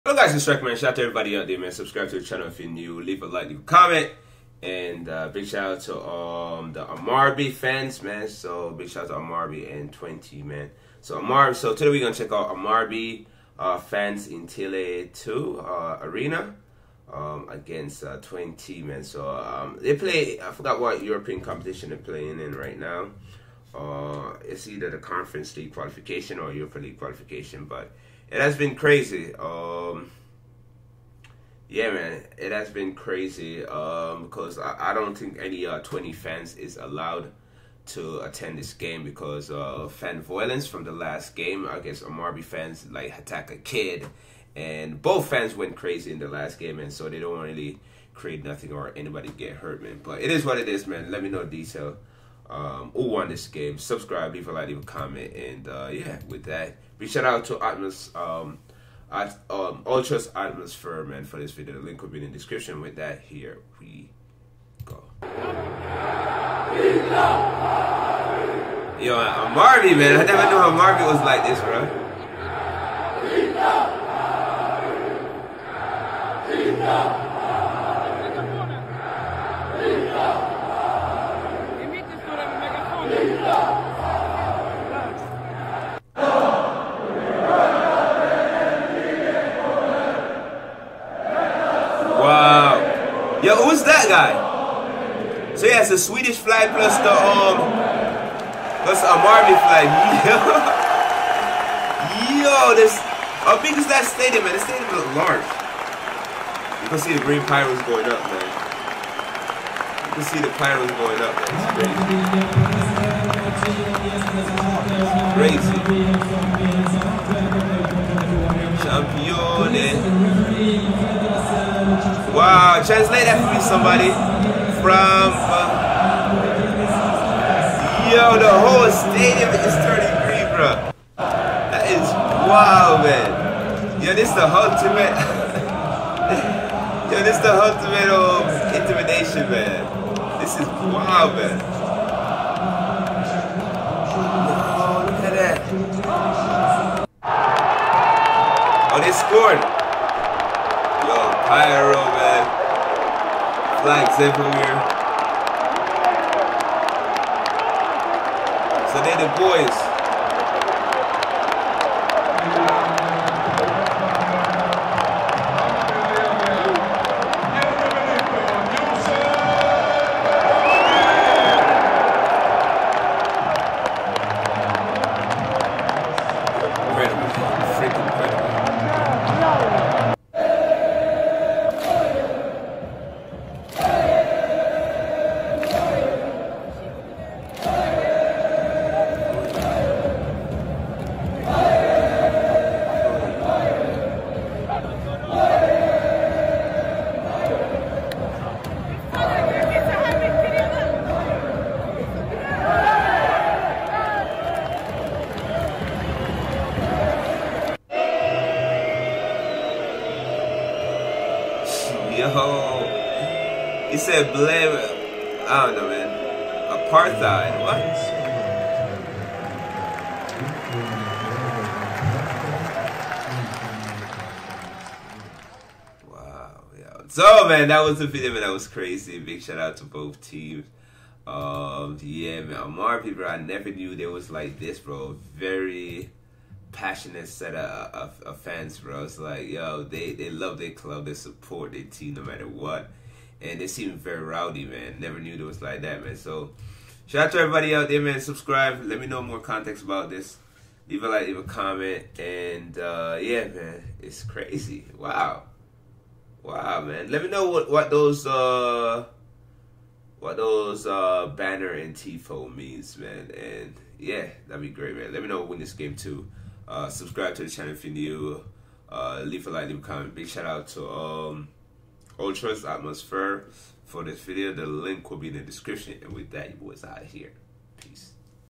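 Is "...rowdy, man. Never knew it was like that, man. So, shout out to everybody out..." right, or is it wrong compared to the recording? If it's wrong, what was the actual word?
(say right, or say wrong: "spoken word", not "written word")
right.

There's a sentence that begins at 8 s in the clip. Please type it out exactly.
So big shout out to Hammarby and Twente, man.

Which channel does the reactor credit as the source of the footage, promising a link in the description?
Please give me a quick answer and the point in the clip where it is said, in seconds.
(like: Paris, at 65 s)
Ultras Atmosphere, at 59 s.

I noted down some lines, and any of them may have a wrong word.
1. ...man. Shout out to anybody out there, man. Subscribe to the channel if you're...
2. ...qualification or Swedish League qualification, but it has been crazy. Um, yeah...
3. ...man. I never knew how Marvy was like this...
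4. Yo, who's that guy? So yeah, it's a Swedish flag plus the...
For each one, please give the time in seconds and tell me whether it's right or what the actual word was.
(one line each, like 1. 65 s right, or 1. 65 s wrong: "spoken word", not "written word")
1. 0 s wrong: "everybody", not "anybody"
2. 25 s wrong: "Europa", not "Swedish"
3. 69 s right
4. 93 s right.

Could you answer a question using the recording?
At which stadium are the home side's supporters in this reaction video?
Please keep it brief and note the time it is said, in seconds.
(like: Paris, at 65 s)
Tele 2 Arena, at 14 s.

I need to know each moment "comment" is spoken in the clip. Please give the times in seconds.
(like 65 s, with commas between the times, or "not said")
3 s, 54 s, 251 s, 269 s.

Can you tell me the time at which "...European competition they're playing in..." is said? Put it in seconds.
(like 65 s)
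21 s.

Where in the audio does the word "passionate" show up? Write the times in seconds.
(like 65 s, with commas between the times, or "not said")
236 s.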